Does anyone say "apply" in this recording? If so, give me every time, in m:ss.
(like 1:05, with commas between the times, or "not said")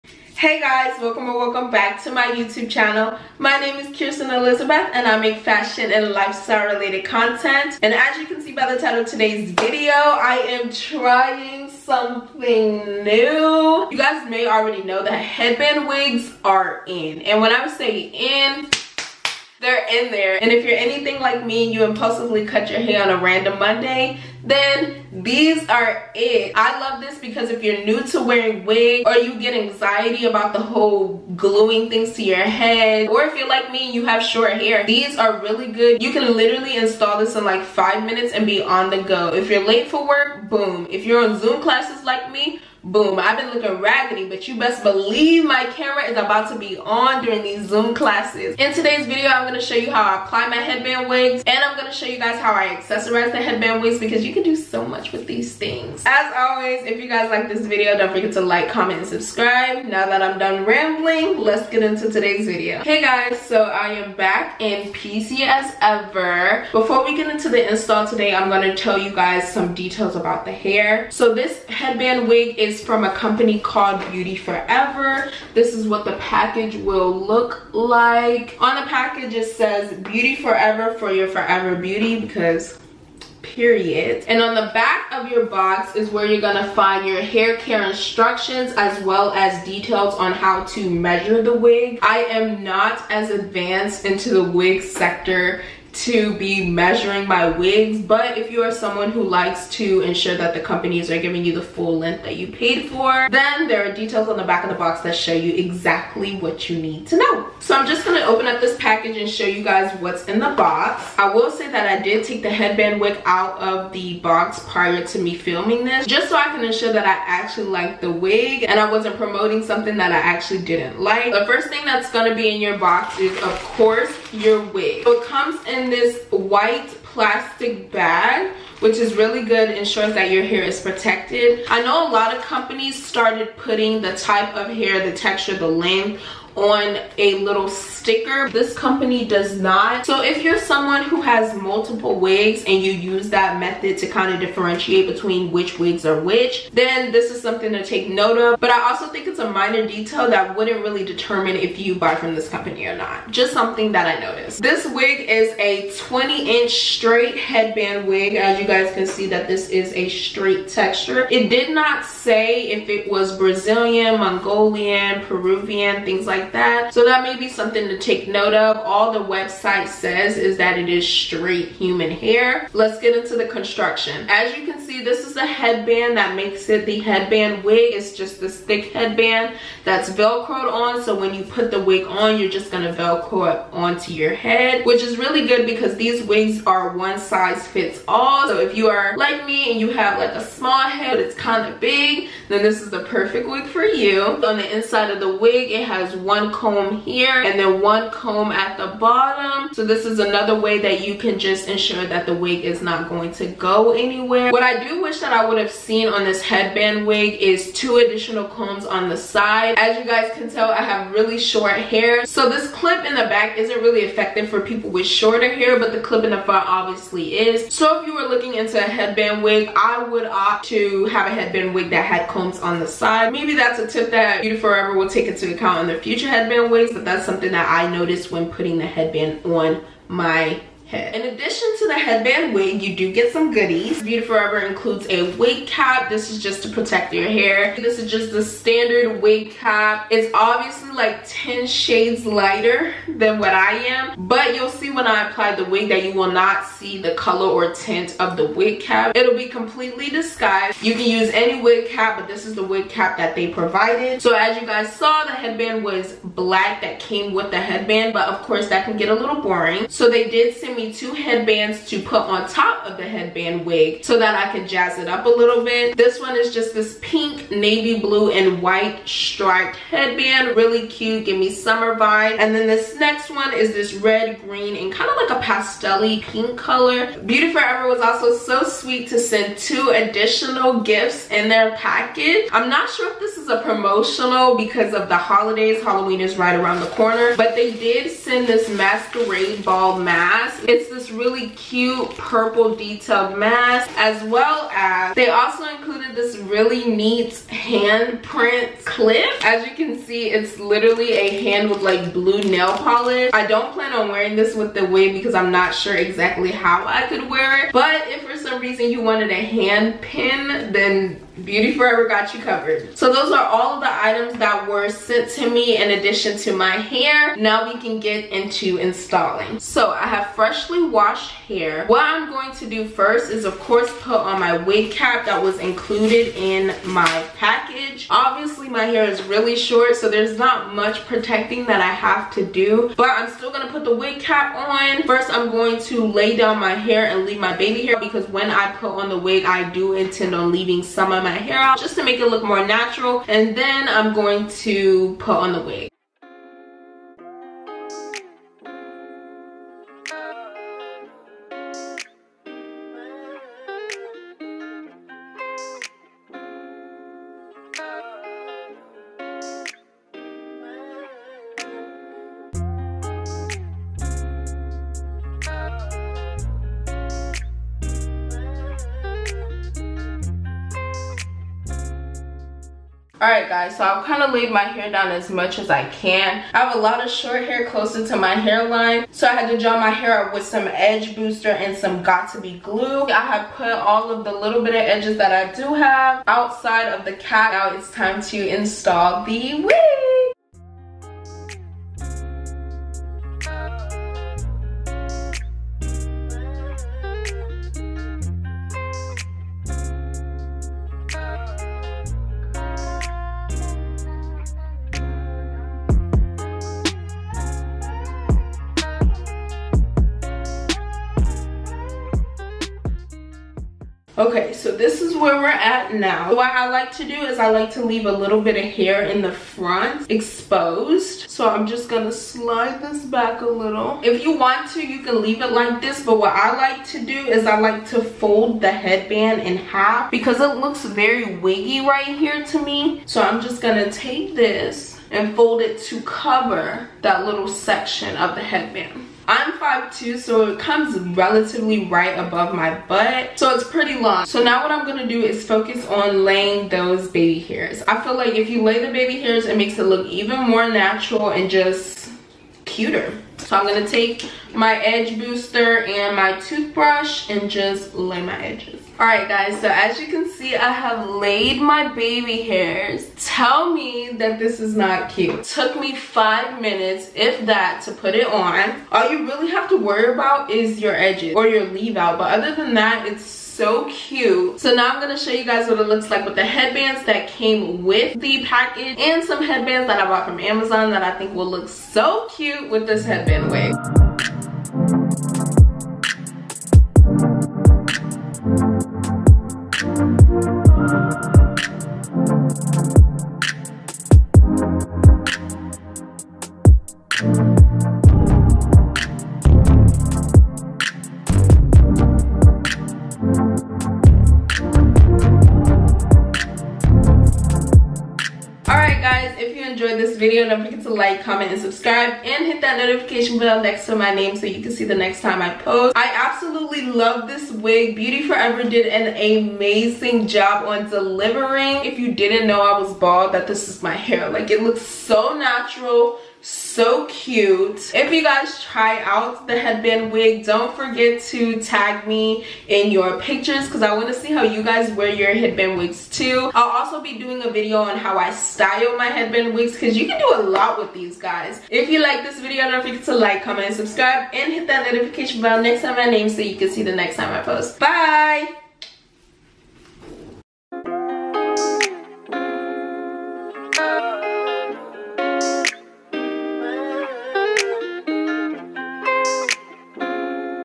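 0:50, 4:05.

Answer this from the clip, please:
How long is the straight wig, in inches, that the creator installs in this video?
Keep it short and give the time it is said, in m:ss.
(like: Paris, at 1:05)
20 inches, at 2:36.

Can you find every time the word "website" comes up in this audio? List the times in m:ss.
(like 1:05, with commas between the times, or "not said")
2:49.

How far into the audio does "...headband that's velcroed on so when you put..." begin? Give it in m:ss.
2:58.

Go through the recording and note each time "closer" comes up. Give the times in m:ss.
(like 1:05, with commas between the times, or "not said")
6:17.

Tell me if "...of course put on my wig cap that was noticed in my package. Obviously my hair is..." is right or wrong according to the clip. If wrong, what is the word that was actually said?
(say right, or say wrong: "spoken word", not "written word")
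wrong: "included", not "noticed".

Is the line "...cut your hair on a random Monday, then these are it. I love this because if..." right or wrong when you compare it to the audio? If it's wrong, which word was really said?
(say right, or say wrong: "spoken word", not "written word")
right.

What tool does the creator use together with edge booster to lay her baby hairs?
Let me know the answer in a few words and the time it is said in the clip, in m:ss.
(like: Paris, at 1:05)
Toothbrush, at 7:36.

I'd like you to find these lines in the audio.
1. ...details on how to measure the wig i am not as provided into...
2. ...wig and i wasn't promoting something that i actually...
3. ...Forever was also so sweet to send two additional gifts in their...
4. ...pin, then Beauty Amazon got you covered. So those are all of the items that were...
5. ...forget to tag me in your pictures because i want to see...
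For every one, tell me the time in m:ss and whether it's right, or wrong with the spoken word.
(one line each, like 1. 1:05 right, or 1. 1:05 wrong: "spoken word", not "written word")
1. 1:29 wrong: "advanced", not "provided"
2. 1:58 right
3. 4:37 right
4. 5:09 wrong: "Forever", not "Amazon"
5. 8:50 right.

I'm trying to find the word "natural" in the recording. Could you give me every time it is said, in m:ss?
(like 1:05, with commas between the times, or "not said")
5:42, 7:30, 8:45.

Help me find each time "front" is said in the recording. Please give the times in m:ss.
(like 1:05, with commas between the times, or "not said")
3:36, 6:59.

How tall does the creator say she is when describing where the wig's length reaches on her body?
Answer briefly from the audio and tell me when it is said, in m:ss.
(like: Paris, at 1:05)
5'2", at 7:19.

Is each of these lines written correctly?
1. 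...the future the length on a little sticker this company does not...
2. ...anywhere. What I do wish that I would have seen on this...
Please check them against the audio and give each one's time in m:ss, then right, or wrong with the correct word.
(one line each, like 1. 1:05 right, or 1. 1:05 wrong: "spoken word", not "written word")
1. 2:15 wrong: "texture", not "future"
2. 3:23 right.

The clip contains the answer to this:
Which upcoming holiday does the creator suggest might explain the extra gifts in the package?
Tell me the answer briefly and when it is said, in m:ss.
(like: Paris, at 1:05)
Halloween, at 4:45.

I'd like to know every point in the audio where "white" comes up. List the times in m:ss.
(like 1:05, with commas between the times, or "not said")
2:06, 4:28.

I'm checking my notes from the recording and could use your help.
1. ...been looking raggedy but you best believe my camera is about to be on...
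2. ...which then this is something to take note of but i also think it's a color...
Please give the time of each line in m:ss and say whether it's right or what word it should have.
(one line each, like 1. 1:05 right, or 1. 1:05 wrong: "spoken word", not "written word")
1. 0:43 right
2. 2:26 wrong: "minor", not "color".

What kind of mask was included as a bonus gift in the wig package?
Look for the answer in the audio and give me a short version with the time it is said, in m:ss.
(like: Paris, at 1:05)
Masquerade ball mask, at 4:48.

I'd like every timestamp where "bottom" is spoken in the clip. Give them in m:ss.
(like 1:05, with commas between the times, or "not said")
3:18.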